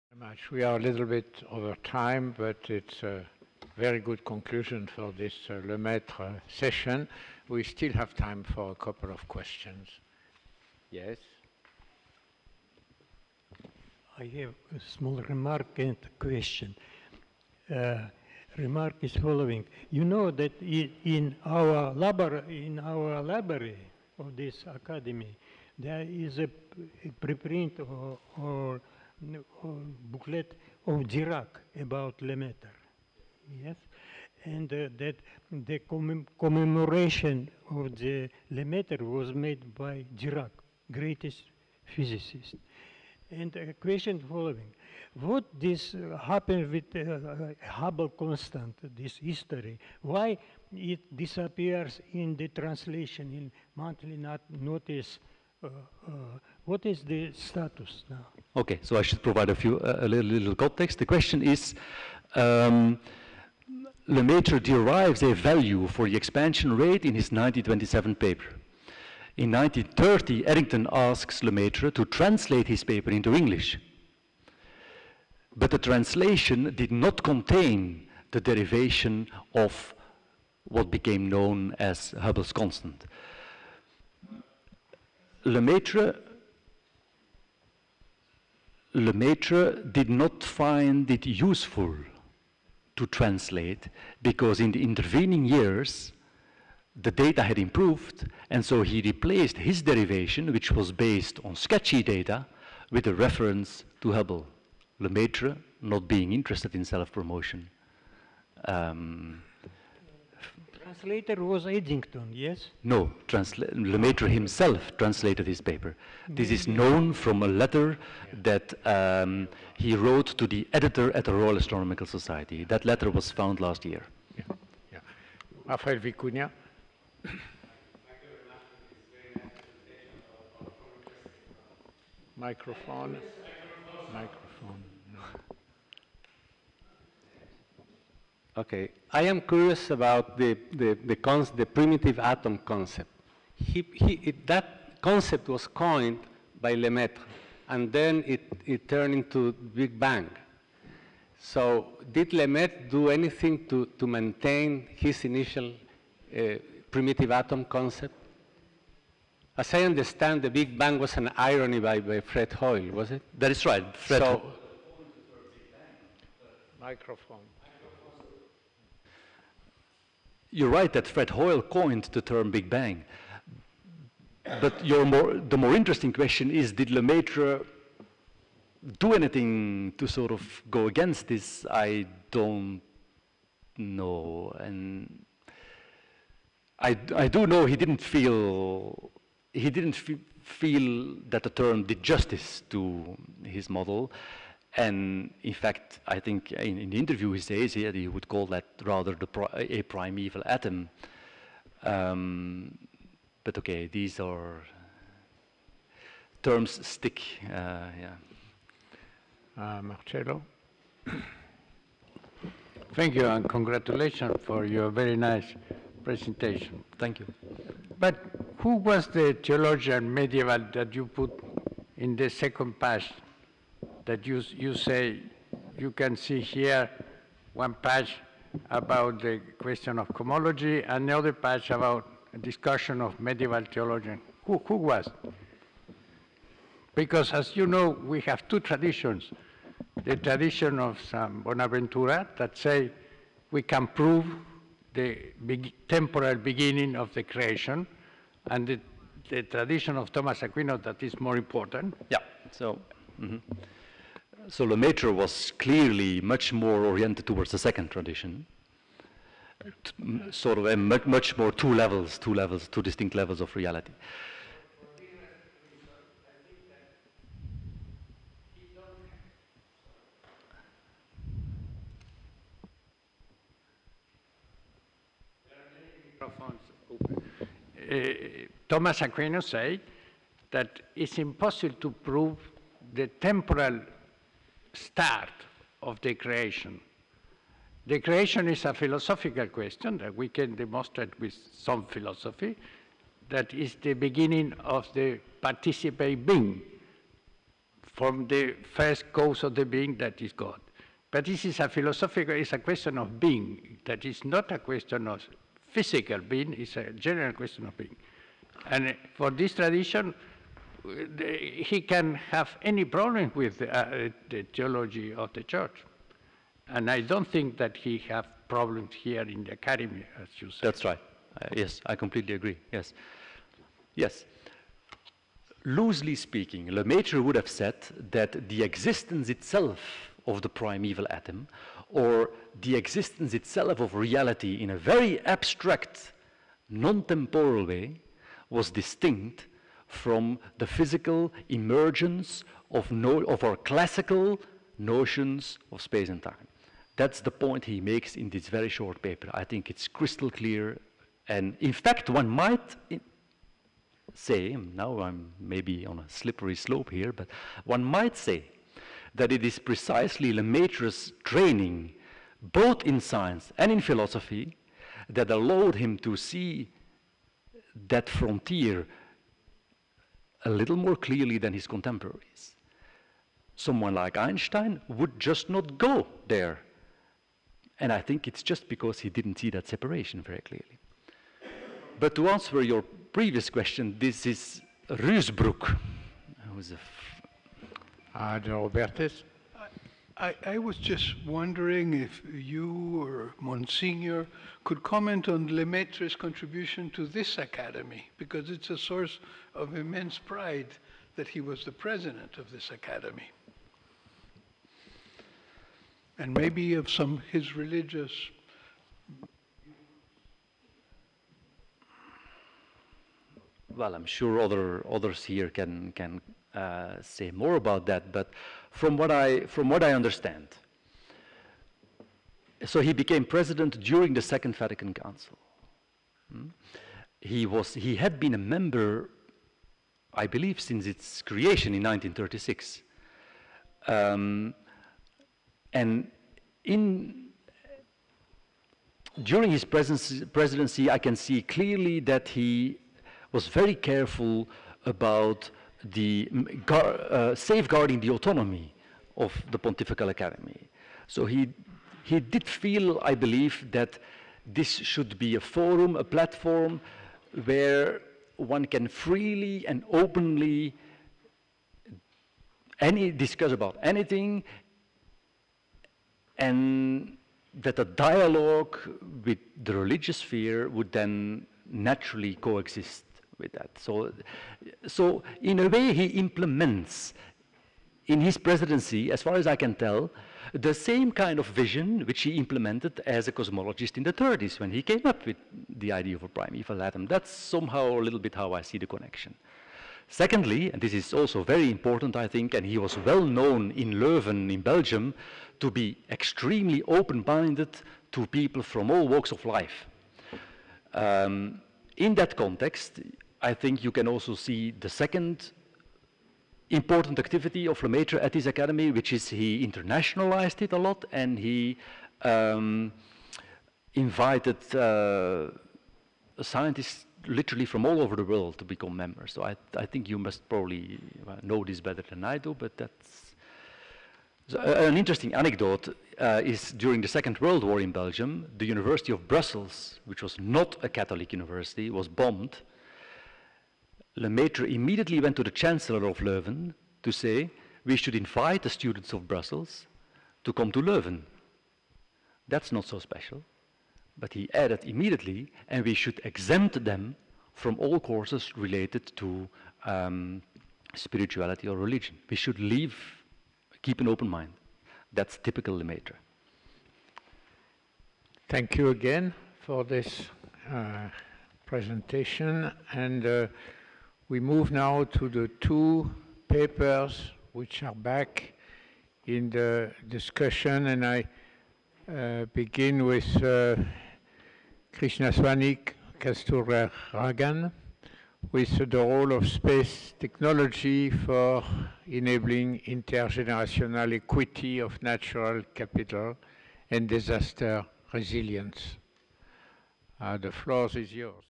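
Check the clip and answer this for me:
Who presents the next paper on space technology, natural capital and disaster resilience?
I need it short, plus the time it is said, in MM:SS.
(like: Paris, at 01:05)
Krishnaswamy Ragan, at 09:34.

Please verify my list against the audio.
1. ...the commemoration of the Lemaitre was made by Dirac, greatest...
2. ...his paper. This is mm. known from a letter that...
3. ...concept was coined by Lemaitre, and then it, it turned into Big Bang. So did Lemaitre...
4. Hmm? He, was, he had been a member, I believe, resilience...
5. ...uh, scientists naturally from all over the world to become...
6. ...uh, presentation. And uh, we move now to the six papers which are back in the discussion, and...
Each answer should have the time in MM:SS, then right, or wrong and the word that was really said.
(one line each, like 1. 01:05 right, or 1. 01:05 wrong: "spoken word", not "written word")
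1. 00:35 right
2. 01:55 right
3. 02:25 right
4. 07:06 wrong: "since", not "resilience"
5. 08:34 wrong: "literally", not "naturally"
6. 09:20 wrong: "two", not "six".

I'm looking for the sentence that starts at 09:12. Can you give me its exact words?
We should leave, keep an open mind.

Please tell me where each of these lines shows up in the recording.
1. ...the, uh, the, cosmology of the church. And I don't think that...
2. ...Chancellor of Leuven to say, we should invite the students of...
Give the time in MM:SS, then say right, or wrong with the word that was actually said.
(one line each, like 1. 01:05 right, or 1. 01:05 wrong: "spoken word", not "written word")
1. 05:13 wrong: "theology", not "cosmology"
2. 08:55 right.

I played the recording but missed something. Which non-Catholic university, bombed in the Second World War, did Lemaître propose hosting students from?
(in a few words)
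University of Brussels.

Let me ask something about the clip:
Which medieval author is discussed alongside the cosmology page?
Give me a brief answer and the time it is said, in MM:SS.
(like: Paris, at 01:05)
Ruusbroec, at 06:24.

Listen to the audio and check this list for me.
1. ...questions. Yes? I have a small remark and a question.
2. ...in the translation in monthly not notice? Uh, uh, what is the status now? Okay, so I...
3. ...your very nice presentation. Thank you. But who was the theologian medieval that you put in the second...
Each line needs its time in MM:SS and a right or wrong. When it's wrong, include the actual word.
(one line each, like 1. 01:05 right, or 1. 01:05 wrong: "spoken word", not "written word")
1. 00:09 right
2. 00:52 right
3. 03:34 right.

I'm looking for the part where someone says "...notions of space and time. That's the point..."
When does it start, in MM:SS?
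05:44.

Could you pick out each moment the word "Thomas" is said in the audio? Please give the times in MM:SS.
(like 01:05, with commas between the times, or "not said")
04:10, 04:38.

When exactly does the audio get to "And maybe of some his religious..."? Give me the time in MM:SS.
06:46.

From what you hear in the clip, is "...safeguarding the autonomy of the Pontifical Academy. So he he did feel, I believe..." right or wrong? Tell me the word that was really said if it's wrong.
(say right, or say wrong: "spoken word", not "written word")
right.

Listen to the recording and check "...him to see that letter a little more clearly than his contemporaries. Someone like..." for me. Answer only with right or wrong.
wrong.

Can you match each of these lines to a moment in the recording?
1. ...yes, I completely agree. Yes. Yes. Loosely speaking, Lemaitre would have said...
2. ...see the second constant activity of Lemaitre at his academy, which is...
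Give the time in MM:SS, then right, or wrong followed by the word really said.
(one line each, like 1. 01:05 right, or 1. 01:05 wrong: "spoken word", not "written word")
1. 05:21 right
2. 08:24 wrong: "important", not "constant".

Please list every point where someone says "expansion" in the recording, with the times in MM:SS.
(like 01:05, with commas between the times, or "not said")
01:06.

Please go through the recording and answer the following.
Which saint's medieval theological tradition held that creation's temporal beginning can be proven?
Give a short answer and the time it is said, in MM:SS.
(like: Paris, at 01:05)
San Bonaventura, at 04:01.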